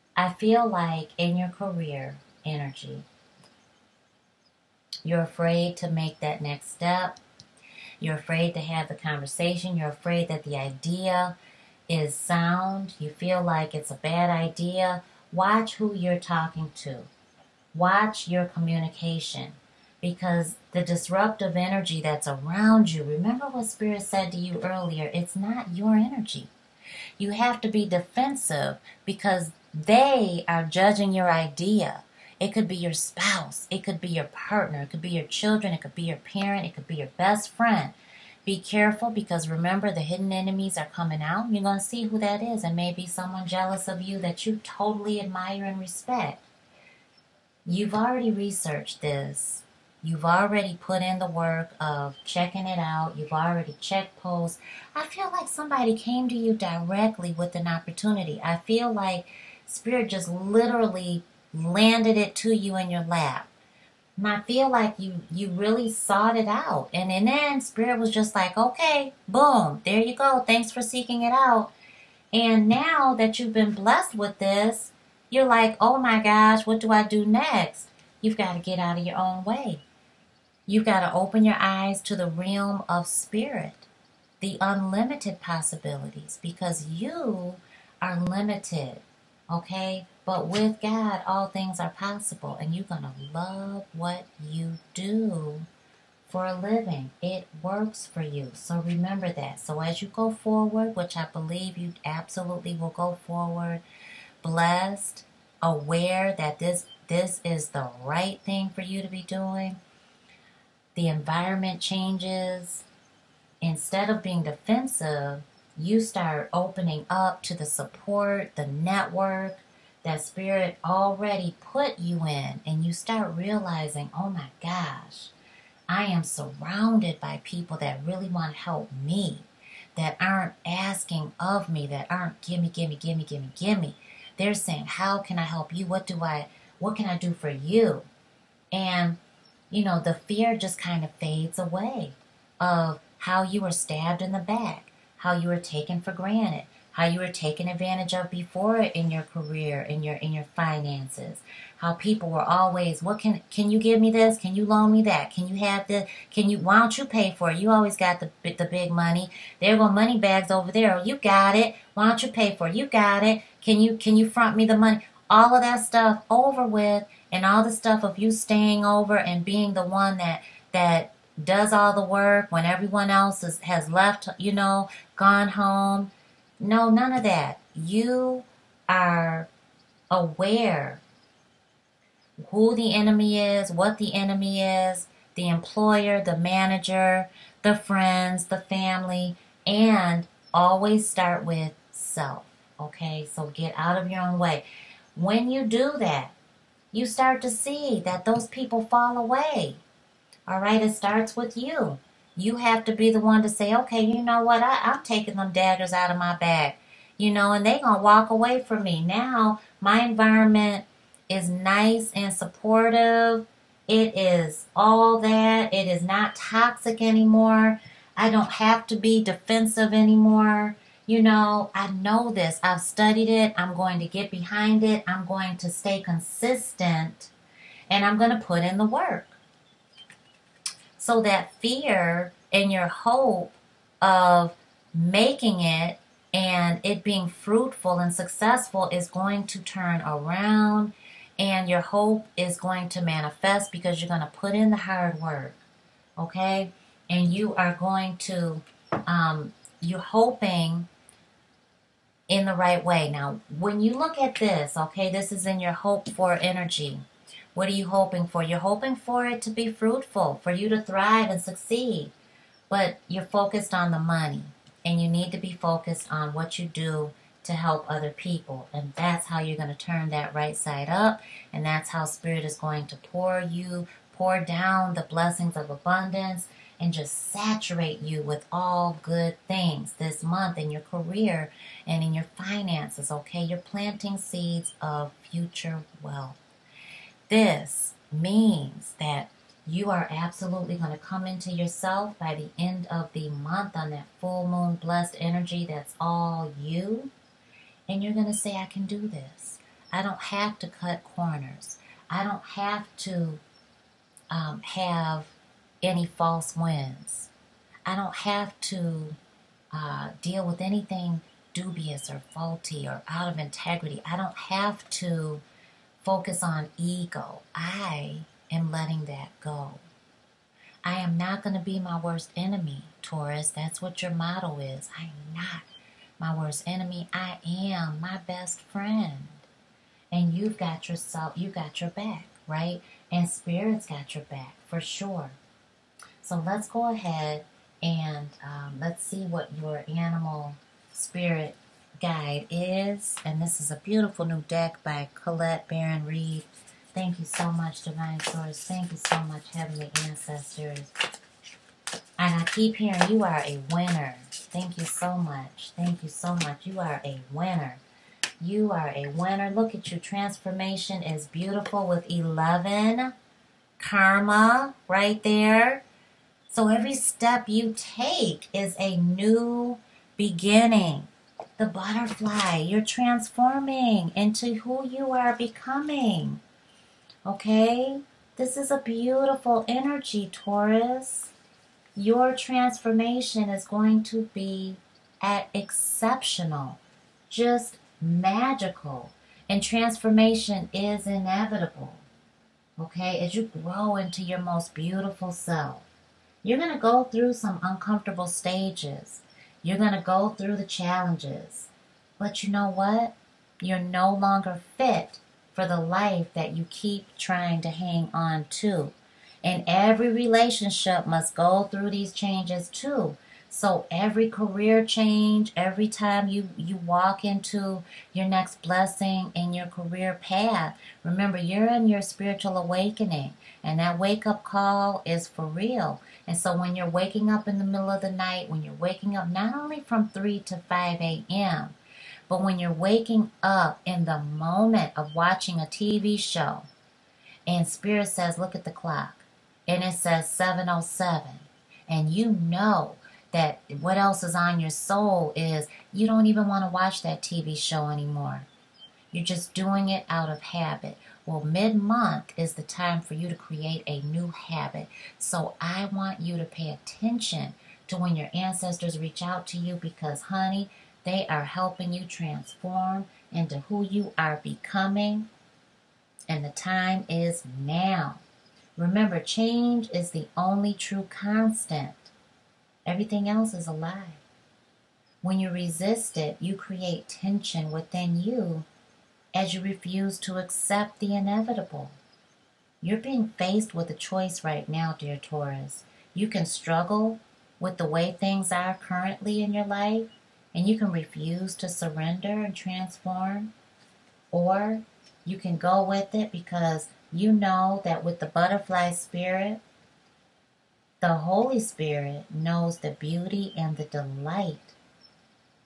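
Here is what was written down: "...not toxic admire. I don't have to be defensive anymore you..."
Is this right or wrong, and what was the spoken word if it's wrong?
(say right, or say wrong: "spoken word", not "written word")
wrong: "anymore", not "admire".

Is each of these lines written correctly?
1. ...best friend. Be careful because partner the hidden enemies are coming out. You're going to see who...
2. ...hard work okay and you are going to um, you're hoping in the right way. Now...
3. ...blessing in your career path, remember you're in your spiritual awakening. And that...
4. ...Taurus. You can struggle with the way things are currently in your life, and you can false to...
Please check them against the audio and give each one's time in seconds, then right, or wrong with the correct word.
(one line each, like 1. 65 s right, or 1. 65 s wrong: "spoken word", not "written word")
1. 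37 s wrong: "remember", not "partner"
2. 244 s right
3. 418 s right
4. 485 s wrong: "refuse", not "false".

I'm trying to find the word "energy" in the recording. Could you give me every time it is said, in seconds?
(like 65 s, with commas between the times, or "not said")
2 s, 21 s, 25 s, 256 s, 295 s, 379 s.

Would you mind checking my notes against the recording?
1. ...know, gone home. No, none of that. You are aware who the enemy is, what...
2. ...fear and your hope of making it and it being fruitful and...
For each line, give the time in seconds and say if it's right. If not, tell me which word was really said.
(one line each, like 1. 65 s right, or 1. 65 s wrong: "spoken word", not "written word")
1. 174 s right
2. 231 s right.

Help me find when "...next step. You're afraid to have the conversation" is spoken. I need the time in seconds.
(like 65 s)
6 s.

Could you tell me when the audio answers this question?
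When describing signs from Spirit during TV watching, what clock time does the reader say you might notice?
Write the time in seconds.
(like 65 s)
440 s.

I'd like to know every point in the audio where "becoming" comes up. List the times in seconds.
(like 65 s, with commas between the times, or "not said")
375 s, 464 s.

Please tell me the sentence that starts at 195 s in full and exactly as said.
When you do that, you start to see that those people fall away.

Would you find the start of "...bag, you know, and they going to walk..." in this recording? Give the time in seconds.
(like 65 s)
206 s.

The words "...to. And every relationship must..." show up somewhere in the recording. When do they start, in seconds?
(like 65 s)
408 s.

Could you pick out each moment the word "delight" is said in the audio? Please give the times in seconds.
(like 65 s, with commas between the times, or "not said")
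503 s.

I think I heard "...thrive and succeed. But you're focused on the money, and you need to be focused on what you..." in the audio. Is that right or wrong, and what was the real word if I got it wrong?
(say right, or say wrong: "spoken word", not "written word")
right.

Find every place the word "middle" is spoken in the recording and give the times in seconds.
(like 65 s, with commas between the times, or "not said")
427 s.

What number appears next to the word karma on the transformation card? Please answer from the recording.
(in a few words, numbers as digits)
11.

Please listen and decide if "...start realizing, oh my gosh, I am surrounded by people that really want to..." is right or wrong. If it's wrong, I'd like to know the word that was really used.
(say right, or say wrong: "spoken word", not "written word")
right.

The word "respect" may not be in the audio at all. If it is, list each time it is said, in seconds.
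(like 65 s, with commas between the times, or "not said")
45 s.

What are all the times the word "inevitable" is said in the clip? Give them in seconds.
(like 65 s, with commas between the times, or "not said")
391 s, 481 s.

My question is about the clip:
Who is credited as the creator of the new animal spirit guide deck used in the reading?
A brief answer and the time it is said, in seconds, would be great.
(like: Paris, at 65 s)
Colette Baron-Reid, at 345 s.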